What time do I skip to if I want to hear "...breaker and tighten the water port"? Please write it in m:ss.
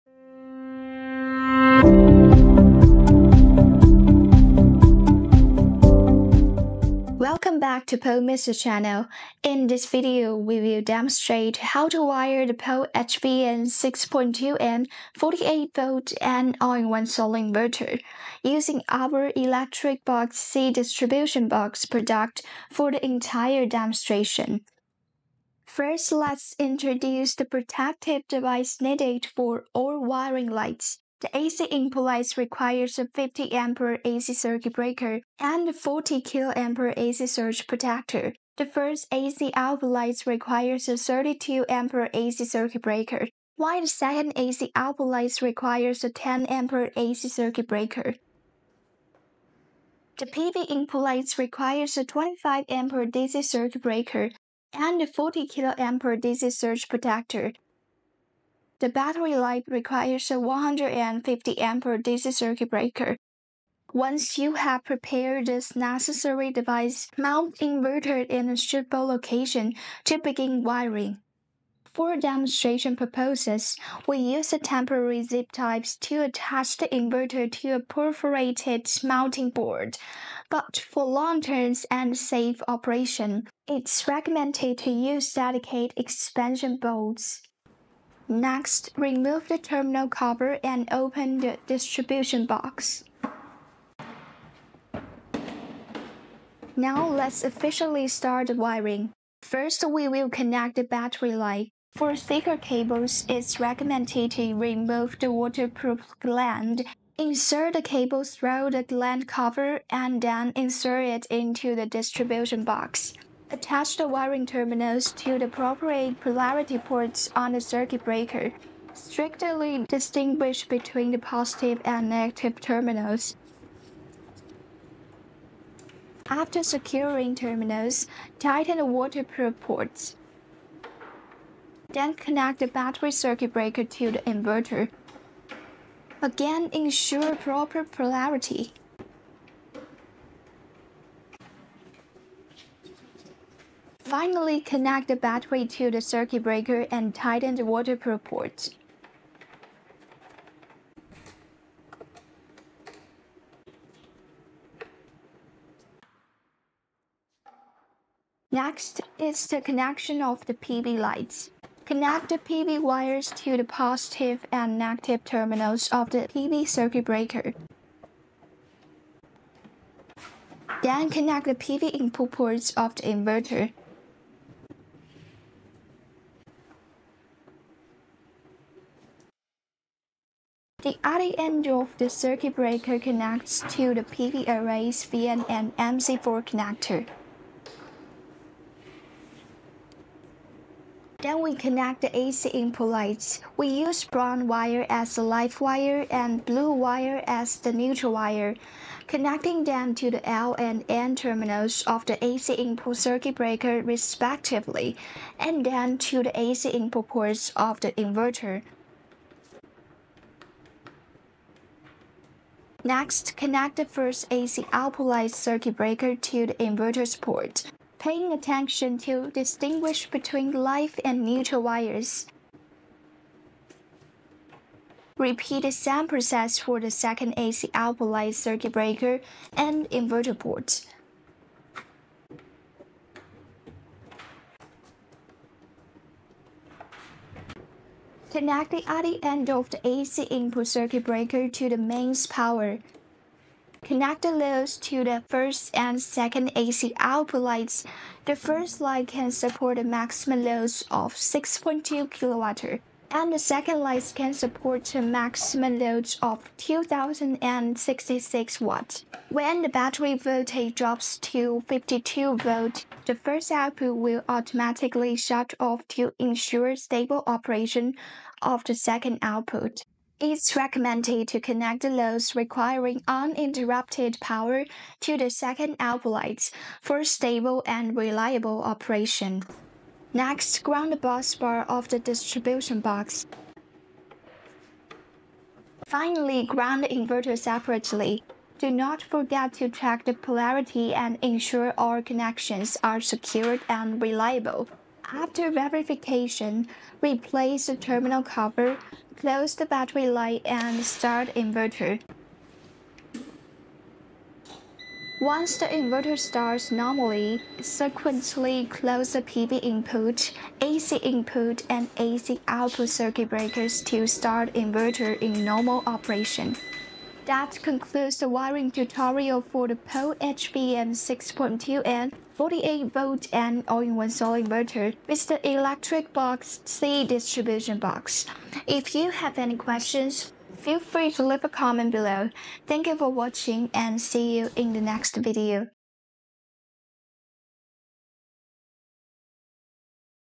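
2:26.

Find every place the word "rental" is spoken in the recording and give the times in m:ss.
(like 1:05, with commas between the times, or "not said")
not said.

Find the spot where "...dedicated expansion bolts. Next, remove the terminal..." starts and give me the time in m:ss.
1:25.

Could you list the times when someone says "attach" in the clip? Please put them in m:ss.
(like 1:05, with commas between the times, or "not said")
1:16, 1:53.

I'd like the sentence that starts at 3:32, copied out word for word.
Next, connect the first AC output light circuit breaker to the inverter's port.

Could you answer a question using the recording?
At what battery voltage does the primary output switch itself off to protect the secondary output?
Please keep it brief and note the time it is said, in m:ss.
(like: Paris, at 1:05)
52 volts, at 4:21.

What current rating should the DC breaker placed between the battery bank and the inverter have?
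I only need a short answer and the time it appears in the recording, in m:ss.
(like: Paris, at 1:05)
150 amperes, at 1:00.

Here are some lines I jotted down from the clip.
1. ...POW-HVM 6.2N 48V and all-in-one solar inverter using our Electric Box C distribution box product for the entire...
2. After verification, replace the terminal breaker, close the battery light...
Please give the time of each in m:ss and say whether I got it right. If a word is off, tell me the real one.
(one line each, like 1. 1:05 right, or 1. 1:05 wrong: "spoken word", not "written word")
1. 0:12 right
2. 4:55 wrong: "cover", not "breaker".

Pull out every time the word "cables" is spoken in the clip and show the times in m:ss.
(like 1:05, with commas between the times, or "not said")
1:42, 1:47.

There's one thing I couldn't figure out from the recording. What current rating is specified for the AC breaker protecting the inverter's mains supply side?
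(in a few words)
50 amperes.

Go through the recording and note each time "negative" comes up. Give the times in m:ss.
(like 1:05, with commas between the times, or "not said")
2:02, 2:44.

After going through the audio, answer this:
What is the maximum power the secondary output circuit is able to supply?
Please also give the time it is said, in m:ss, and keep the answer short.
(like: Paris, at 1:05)
2066 watts, at 4:16.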